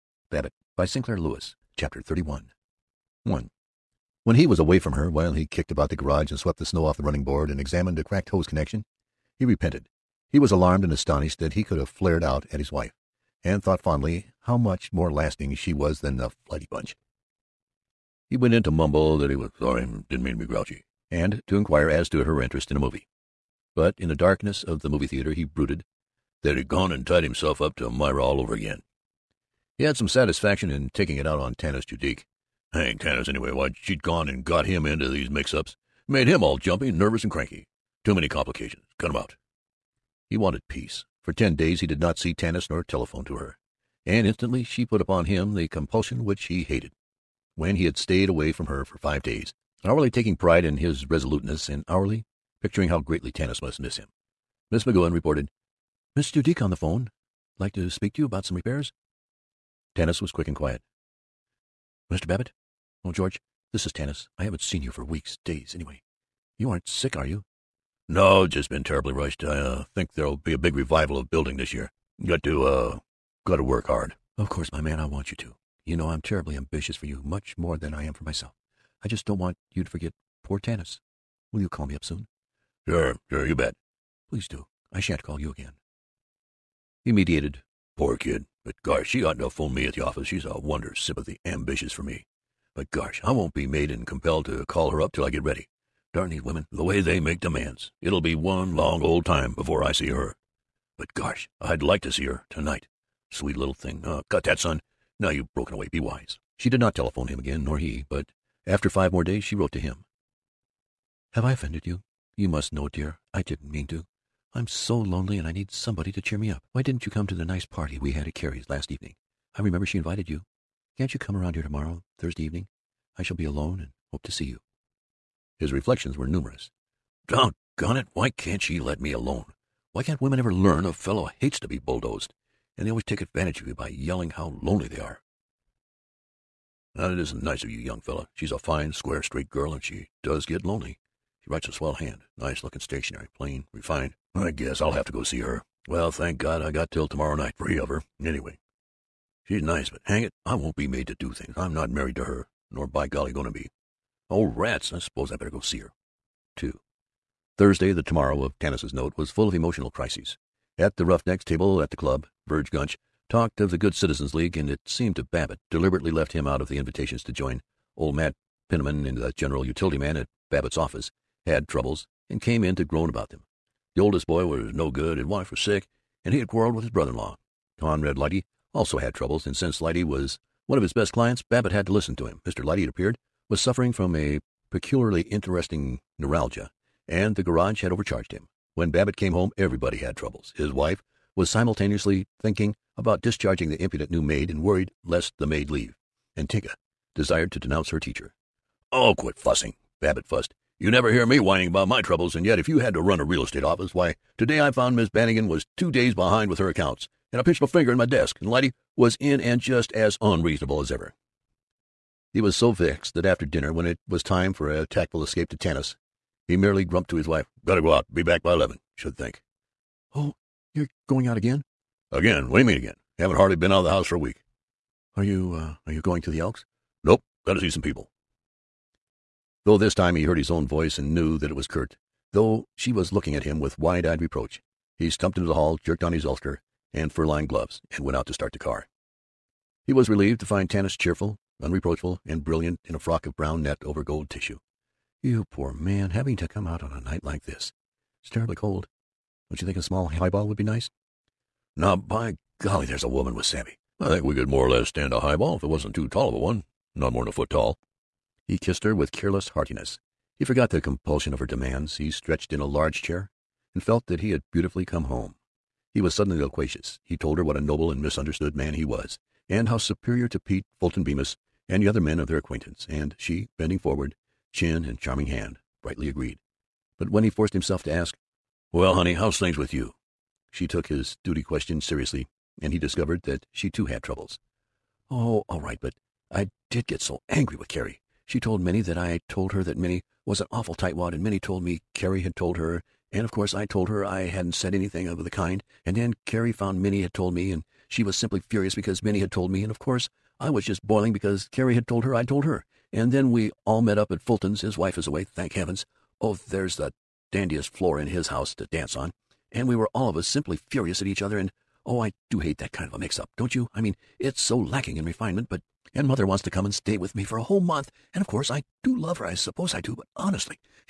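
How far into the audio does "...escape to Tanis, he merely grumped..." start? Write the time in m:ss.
3:35.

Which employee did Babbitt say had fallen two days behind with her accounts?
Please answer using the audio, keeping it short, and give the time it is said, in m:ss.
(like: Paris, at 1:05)
Miss Bannigan, at 3:24.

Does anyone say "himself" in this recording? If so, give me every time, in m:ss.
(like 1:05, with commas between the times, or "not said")
0:27, 4:37.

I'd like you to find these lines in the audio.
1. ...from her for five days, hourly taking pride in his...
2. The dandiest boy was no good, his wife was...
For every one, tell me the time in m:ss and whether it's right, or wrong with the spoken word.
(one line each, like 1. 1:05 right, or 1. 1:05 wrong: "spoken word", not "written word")
1. 0:48 right
2. 2:53 wrong: "oldest", not "dandiest".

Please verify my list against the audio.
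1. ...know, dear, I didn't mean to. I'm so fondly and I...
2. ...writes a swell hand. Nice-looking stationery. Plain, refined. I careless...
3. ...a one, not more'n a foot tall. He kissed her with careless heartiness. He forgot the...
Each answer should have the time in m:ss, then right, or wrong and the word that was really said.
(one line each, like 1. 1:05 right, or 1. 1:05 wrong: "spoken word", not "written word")
1. 1:52 wrong: "lonely", not "fondly"
2. 2:21 wrong: "guess", not "careless"
3. 4:16 right.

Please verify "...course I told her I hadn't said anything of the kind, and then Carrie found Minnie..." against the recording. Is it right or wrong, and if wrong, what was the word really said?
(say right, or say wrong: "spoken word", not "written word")
right.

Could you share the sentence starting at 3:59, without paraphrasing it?
He was relieved to find Tanis cheerful, unreproachful, and brilliant in a frock of brown net over gold tissue.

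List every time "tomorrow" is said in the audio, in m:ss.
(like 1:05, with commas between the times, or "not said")
2:01, 2:38.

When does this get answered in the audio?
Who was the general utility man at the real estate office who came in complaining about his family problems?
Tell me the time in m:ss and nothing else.
2:48.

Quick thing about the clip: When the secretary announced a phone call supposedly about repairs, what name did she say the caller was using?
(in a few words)
Mr. Duke.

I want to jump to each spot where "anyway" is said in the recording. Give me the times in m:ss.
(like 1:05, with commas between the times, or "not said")
0:33, 1:05, 2:28.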